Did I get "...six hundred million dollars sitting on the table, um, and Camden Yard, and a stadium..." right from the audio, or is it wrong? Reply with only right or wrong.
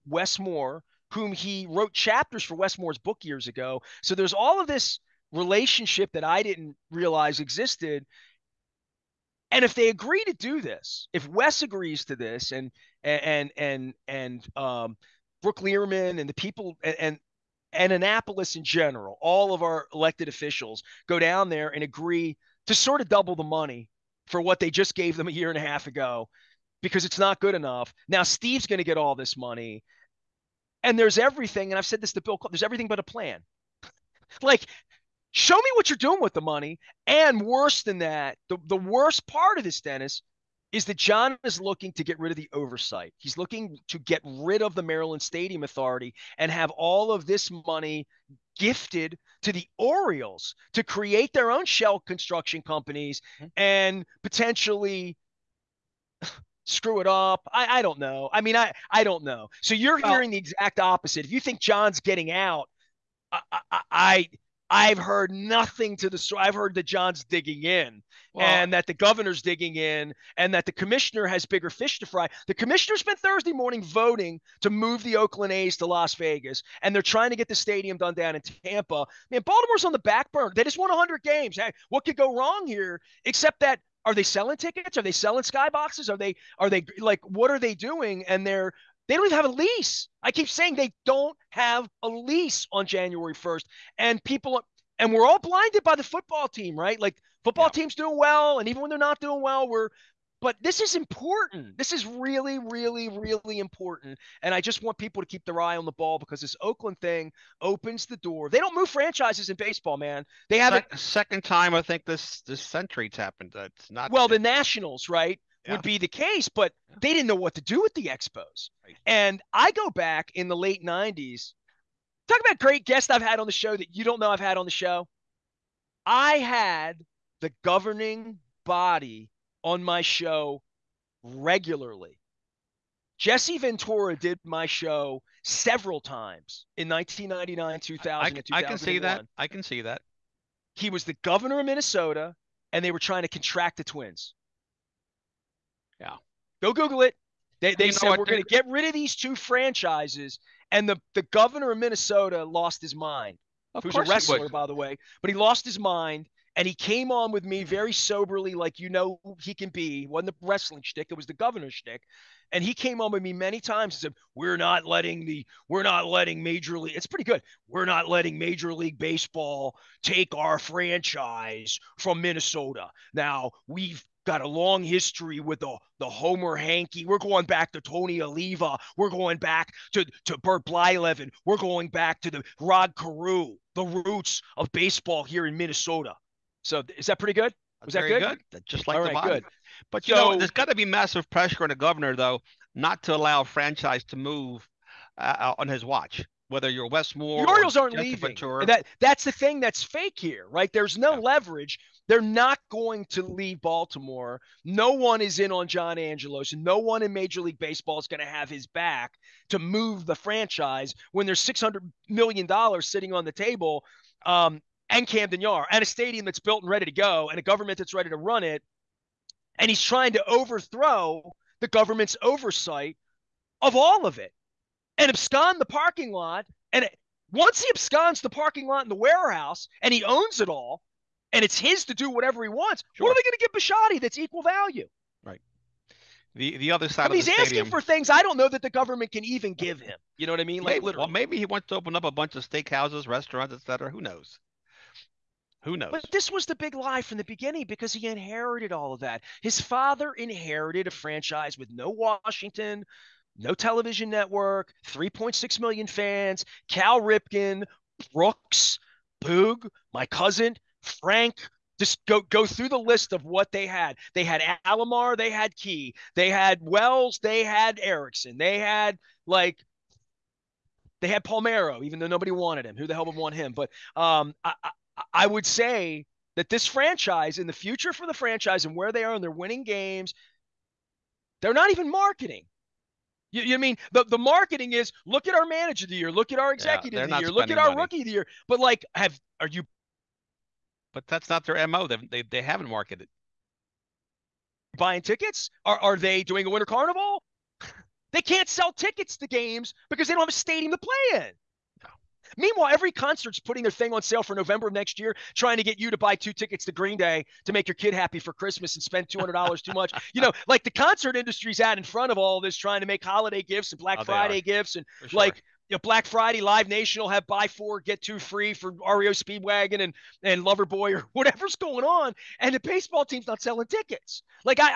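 right.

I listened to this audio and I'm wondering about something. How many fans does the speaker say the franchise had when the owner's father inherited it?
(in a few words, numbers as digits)
3.6 million.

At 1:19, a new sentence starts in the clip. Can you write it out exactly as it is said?
Man, Baltimore's on the back burner.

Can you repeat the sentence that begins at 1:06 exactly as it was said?
I've heard that John's digging in well, and that the governor's digging in and that the commissioner has bigger fish to fry.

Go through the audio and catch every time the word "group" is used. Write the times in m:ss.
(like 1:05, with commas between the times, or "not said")
not said.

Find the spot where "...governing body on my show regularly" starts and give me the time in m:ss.
2:07.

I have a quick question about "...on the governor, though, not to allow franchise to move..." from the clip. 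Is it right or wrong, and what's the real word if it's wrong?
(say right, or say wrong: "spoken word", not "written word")
right.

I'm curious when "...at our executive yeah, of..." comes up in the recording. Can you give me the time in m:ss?
4:46.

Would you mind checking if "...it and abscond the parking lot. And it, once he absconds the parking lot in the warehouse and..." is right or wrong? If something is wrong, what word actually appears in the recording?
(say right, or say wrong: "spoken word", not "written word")
right.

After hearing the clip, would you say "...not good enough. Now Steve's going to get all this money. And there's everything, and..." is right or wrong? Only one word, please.
right.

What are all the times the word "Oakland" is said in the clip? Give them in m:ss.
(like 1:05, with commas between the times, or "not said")
1:15, 1:46.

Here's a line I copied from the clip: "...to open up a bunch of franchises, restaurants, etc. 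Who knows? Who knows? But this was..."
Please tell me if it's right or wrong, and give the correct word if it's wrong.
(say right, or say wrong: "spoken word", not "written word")
wrong: "steakhouses", not "franchises".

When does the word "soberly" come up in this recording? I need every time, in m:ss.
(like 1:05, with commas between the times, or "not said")
2:37.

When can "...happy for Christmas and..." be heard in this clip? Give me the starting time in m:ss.
5:07.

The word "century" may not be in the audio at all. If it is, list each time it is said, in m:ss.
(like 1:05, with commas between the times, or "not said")
1:52.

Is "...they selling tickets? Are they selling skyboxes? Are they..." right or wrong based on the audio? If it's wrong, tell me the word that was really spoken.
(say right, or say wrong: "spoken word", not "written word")
right.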